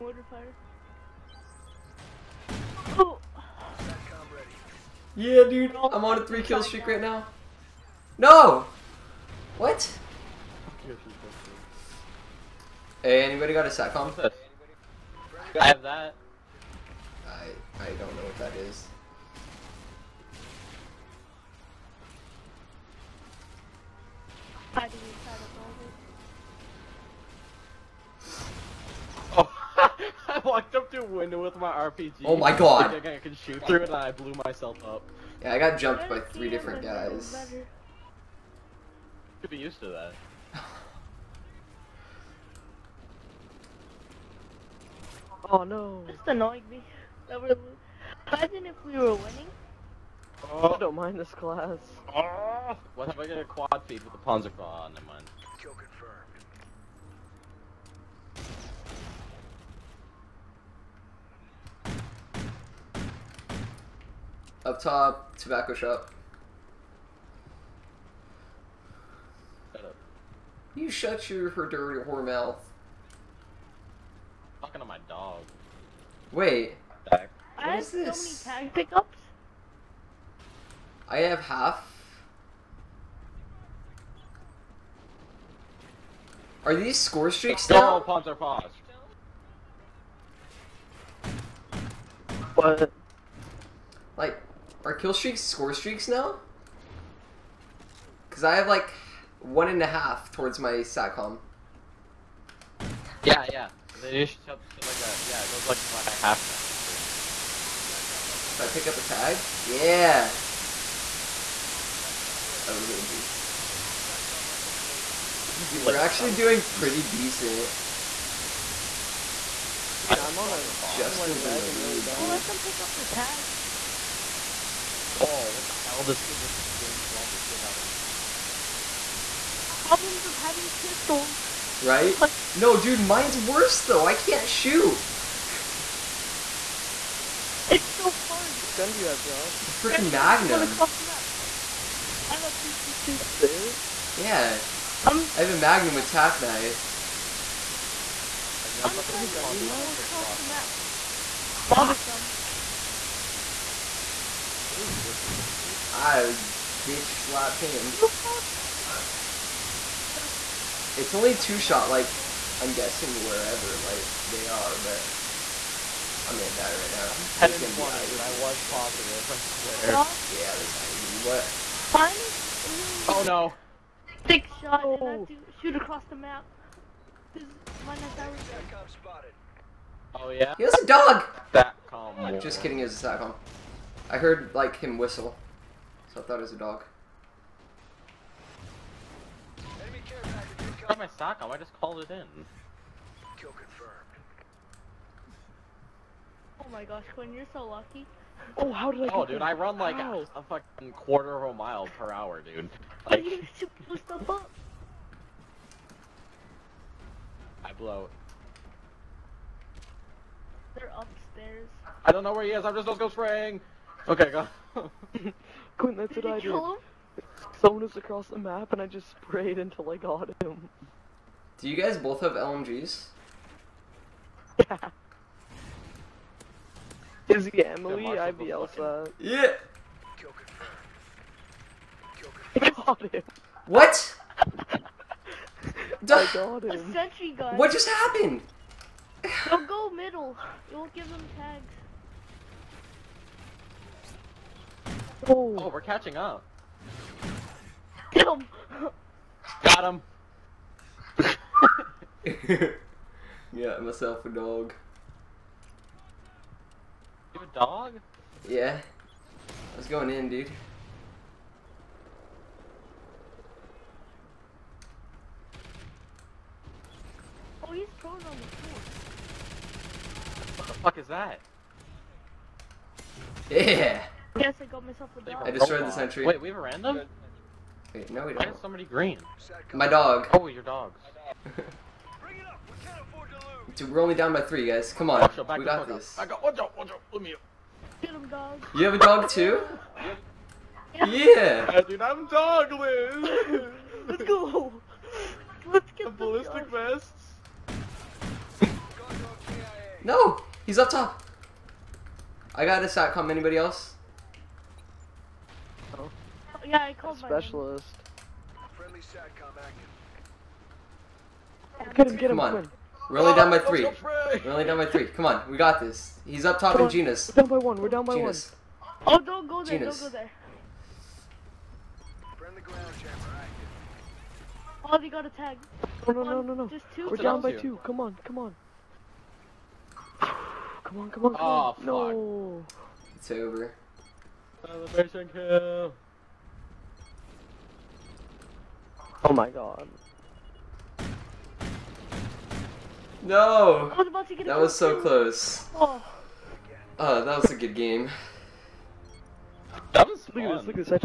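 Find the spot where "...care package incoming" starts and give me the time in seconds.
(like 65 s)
190 s.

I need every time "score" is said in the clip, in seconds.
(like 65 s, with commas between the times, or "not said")
86 s, 95 s.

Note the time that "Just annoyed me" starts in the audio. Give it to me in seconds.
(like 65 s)
46 s.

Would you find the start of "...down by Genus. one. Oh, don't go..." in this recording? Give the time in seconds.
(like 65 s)
317 s.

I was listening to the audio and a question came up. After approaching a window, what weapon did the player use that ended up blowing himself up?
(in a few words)
RPG.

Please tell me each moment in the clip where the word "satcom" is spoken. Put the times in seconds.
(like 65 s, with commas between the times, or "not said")
13 s, 100 s, 183 s, 302 s, 308 s.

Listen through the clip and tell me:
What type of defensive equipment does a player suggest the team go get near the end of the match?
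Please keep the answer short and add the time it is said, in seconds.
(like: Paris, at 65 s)
ballistic vests, at 296 s.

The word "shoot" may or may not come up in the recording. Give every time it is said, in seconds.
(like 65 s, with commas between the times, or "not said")
33 s, 134 s, 175 s.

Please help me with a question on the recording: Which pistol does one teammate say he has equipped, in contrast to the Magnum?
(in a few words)
P226.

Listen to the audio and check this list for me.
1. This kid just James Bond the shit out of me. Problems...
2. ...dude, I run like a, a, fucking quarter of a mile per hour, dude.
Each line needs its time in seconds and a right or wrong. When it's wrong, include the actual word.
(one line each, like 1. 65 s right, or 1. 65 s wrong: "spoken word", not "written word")
1. 126 s right
2. 199 s right.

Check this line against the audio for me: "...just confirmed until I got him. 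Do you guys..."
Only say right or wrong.
wrong.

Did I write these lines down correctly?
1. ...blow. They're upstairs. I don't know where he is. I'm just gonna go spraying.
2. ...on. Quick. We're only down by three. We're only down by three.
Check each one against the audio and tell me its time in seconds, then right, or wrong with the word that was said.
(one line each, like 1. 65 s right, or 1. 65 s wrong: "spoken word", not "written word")
1. 207 s right
2. 312 s right.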